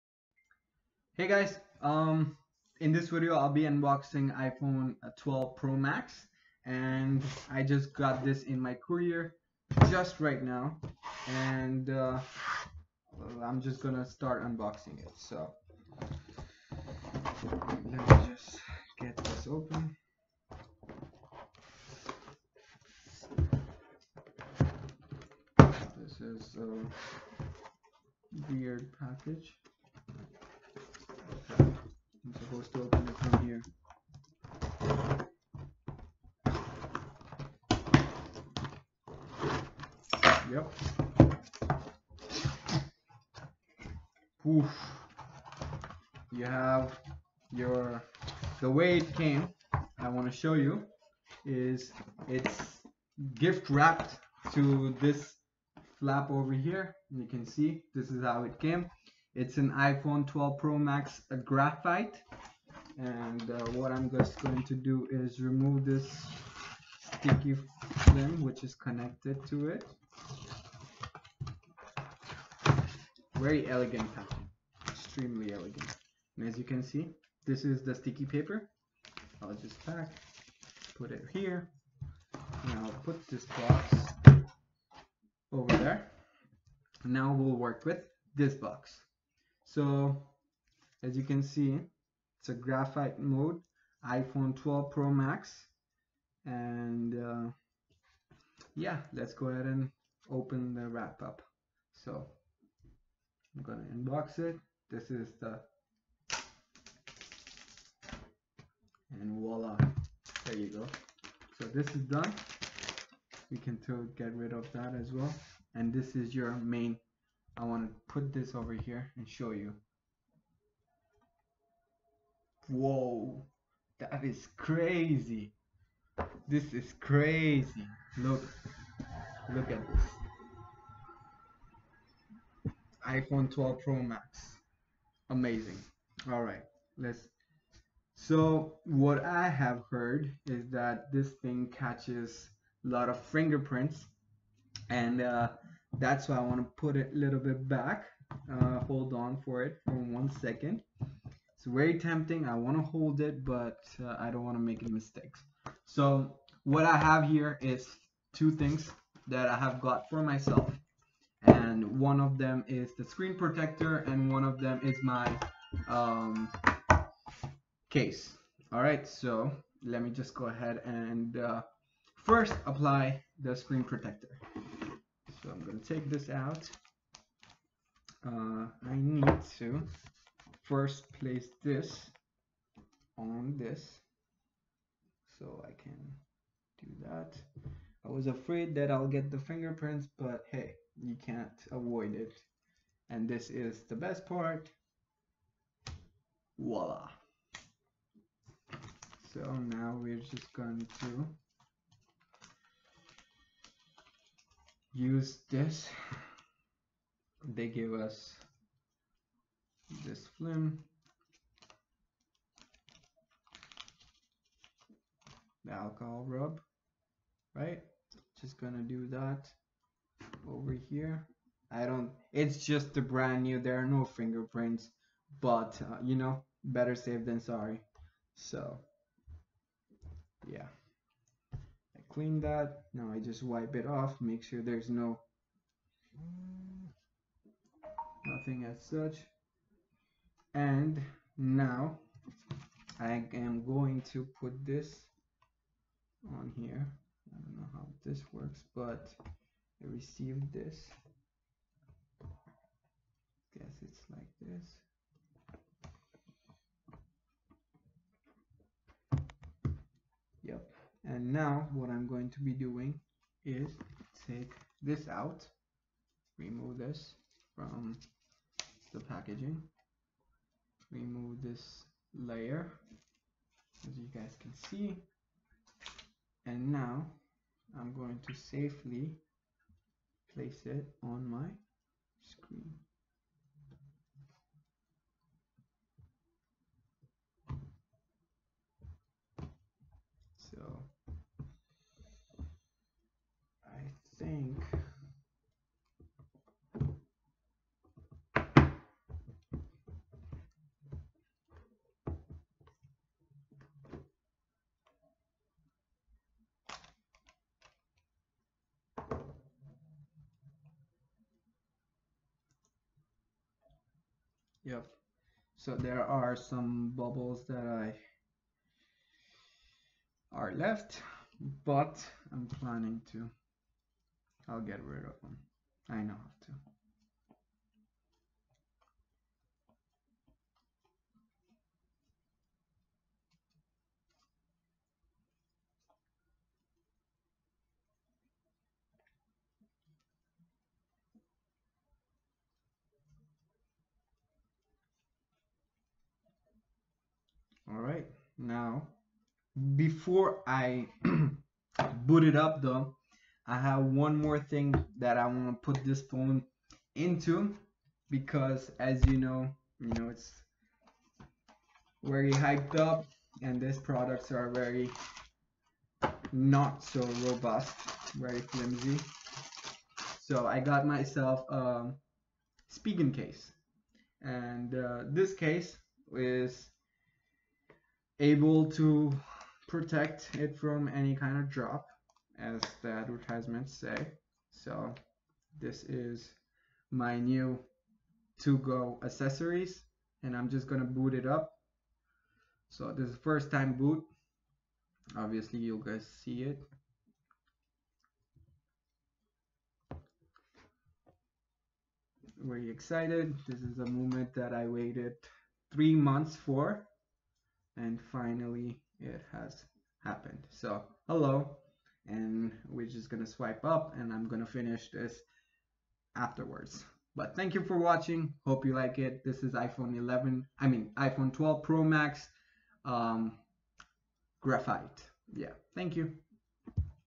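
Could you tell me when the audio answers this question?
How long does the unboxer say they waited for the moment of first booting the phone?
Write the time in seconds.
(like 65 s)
405 s.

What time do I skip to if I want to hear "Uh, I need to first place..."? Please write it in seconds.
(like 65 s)
178 s.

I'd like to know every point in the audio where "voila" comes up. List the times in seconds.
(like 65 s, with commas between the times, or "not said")
109 s, 196 s.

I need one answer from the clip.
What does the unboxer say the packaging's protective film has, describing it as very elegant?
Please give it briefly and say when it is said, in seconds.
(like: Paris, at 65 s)
pattern, at 74 s.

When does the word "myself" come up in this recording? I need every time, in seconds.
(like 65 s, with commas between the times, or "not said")
160 s, 370 s.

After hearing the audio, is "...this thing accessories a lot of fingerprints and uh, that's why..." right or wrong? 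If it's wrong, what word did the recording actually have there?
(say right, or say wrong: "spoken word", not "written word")
wrong: "catches", not "accessories".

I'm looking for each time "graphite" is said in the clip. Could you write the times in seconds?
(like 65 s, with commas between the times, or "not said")
61 s, 92 s, 424 s.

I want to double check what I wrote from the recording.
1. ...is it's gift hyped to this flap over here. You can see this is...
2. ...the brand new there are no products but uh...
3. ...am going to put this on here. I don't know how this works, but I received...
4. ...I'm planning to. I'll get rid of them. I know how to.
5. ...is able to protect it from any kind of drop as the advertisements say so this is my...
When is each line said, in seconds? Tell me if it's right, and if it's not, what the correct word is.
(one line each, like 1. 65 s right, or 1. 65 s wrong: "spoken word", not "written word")
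1. 51 s wrong: "wrapped", not "hyped"
2. 222 s wrong: "fingerprints", not "products"
3. 243 s right
4. 322 s right
5. 376 s right.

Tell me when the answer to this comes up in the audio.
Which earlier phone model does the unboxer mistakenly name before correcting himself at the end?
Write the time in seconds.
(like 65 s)
419 s.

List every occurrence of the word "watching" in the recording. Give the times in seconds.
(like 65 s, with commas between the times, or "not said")
417 s.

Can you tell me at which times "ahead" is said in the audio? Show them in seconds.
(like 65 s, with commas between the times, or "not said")
99 s, 170 s.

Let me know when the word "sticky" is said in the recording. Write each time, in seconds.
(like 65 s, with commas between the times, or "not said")
67 s, 77 s.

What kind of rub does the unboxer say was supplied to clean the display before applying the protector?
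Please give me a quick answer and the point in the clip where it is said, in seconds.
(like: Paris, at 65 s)
alcohol rub, at 215 s.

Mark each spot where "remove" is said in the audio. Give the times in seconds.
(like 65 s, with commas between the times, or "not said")
65 s, 266 s, 270 s.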